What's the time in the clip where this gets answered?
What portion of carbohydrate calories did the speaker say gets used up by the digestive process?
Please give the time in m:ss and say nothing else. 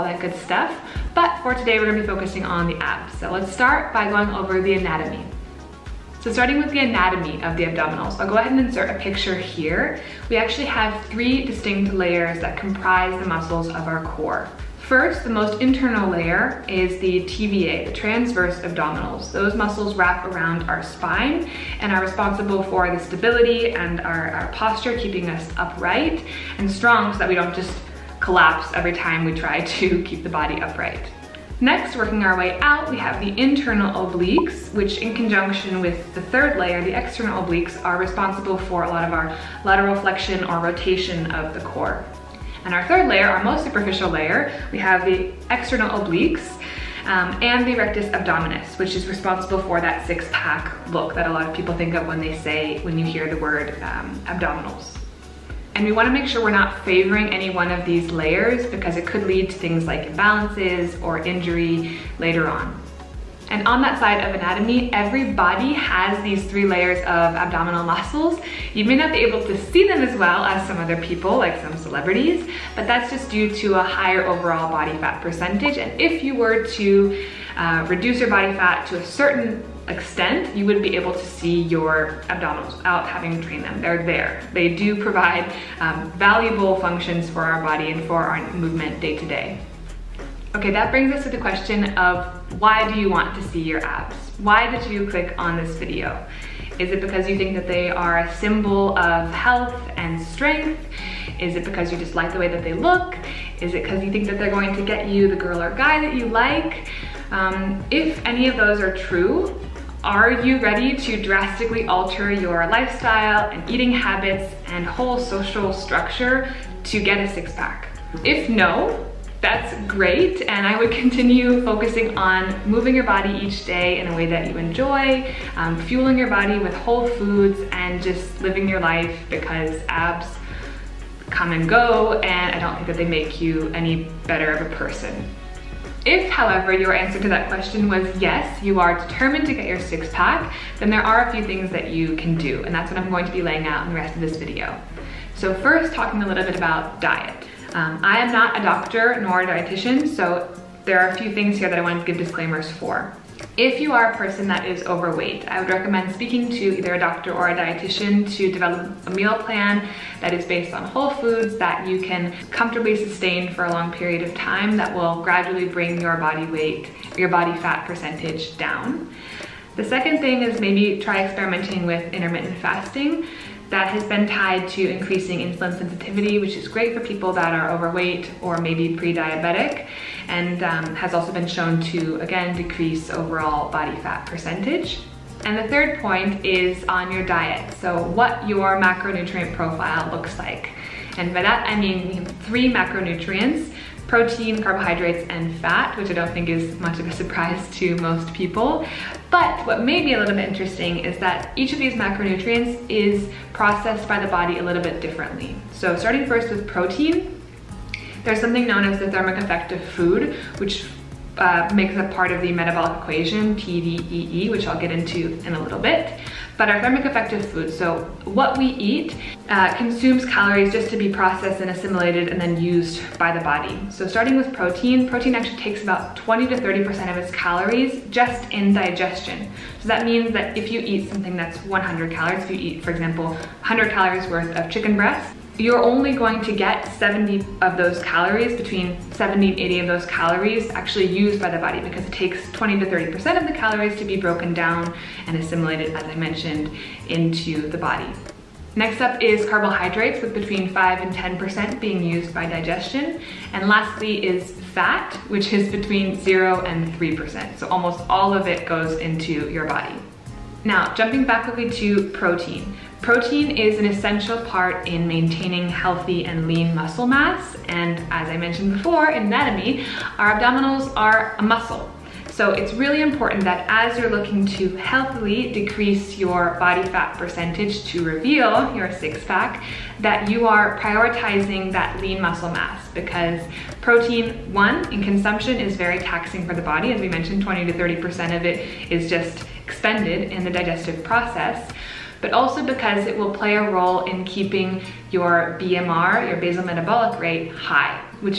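4:10.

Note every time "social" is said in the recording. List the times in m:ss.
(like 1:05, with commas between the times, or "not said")
1:55.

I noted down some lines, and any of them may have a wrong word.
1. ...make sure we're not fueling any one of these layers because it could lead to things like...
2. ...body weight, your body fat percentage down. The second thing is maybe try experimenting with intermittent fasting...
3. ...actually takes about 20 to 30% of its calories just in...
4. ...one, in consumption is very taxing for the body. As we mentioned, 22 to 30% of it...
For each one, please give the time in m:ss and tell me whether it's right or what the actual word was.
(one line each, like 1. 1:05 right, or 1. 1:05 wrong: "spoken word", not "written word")
1. 0:56 wrong: "favoring", not "fueling"
2. 2:46 right
3. 3:45 right
4. 4:44 wrong: "20", not "22".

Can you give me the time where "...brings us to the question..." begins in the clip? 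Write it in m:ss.
1:30.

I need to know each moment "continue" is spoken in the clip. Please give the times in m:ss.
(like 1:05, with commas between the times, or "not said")
2:00.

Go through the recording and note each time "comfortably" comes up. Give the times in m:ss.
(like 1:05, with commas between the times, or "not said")
2:42.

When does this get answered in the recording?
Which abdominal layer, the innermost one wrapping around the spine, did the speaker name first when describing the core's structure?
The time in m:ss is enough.
0:17.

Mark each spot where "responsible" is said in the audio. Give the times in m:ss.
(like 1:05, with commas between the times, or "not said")
0:22, 0:37, 0:49.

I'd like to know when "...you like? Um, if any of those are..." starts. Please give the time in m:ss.
1:46.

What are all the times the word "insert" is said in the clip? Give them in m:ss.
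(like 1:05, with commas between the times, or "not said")
0:08.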